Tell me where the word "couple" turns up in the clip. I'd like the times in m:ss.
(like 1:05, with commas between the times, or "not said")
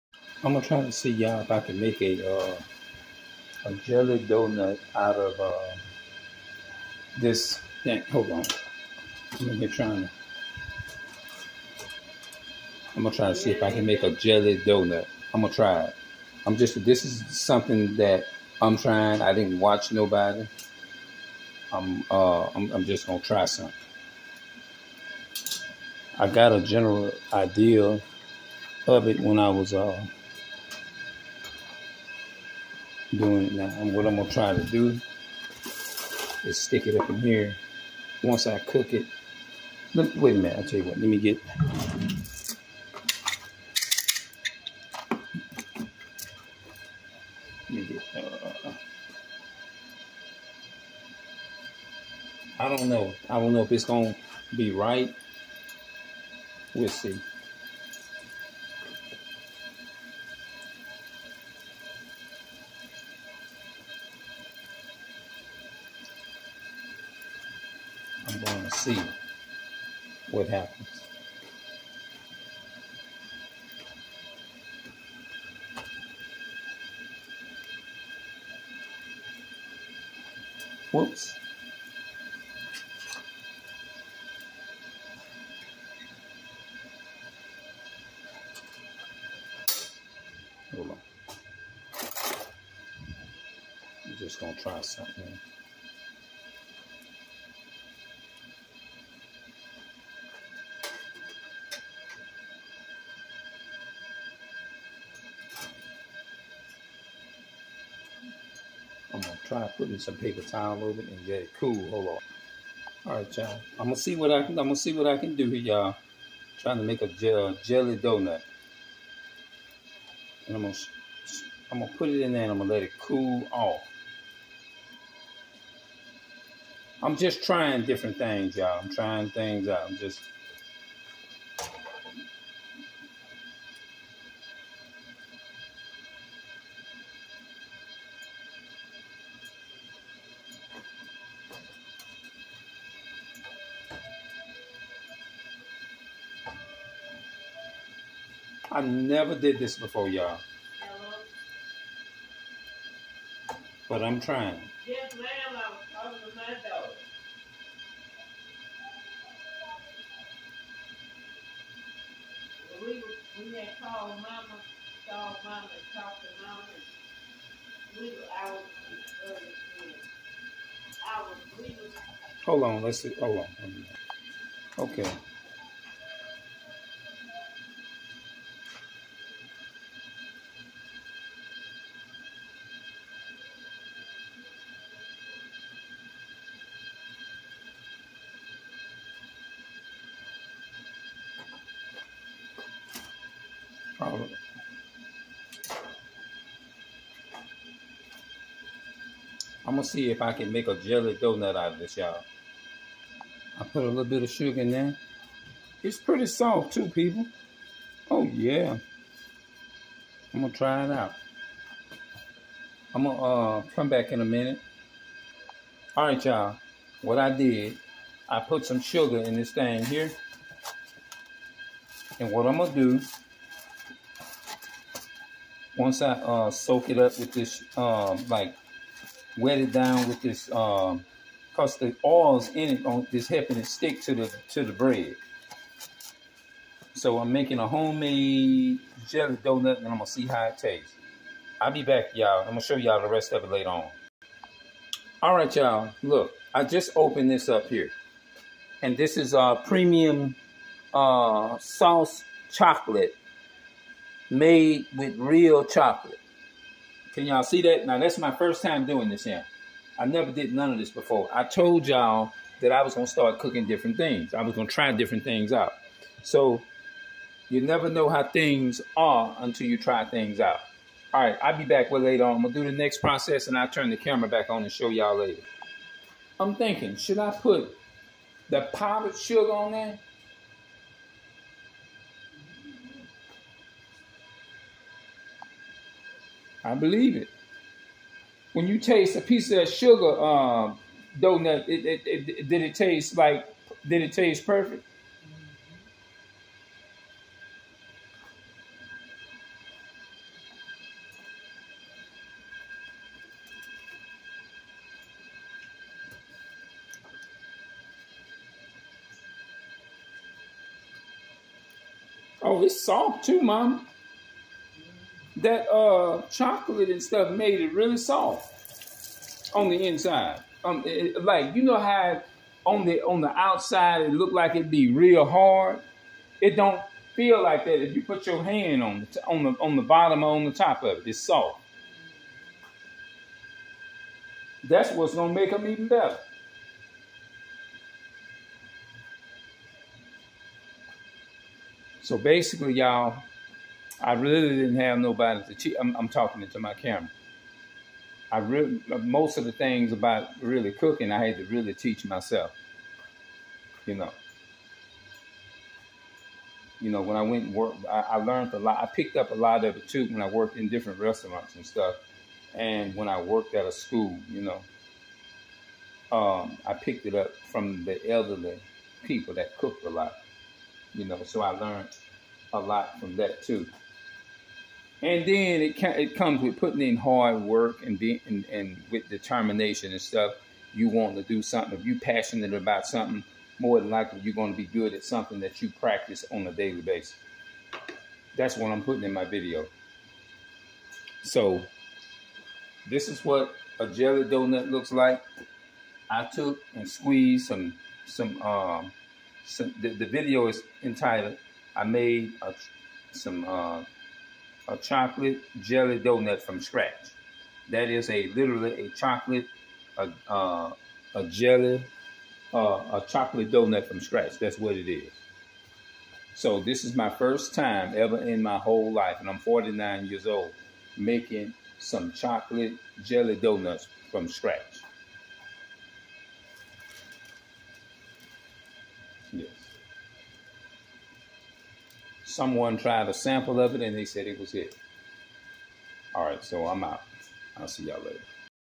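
not said.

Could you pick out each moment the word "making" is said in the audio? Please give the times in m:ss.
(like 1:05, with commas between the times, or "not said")
3:57, 7:00.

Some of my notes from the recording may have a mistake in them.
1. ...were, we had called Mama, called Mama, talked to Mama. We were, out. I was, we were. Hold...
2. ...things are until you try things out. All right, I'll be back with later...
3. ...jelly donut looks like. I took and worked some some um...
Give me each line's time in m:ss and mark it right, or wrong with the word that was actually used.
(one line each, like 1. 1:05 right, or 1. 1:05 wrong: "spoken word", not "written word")
1. 2:42 right
2. 4:28 right
3. 6:33 wrong: "squeezed", not "worked".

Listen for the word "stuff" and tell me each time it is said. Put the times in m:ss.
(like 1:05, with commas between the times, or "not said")
5:17, 6:01, 6:20.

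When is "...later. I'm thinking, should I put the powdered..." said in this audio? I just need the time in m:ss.
4:35.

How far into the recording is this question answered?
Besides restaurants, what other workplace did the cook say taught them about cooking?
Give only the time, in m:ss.
6:03.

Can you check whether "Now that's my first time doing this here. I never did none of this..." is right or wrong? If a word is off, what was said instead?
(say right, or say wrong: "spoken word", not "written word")
right.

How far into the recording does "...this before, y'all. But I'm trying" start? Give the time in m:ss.
2:29.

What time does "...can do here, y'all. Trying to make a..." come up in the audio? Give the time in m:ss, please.
1:55.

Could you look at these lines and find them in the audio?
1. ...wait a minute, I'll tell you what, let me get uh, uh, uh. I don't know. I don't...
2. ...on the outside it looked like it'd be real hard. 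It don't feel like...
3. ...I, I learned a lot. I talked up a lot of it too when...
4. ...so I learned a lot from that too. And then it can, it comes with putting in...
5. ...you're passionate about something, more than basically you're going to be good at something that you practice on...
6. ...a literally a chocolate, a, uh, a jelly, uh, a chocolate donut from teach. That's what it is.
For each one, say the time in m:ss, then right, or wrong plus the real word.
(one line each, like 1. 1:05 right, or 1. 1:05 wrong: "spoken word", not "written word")
1. 0:40 right
2. 5:23 right
3. 5:57 wrong: "picked", not "talked"
4. 6:11 right
5. 6:21 wrong: "likely", not "basically"
6. 6:48 wrong: "scratch", not "teach".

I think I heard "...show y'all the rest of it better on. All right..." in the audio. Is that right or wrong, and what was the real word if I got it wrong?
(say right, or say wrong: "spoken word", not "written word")
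wrong: "later", not "better".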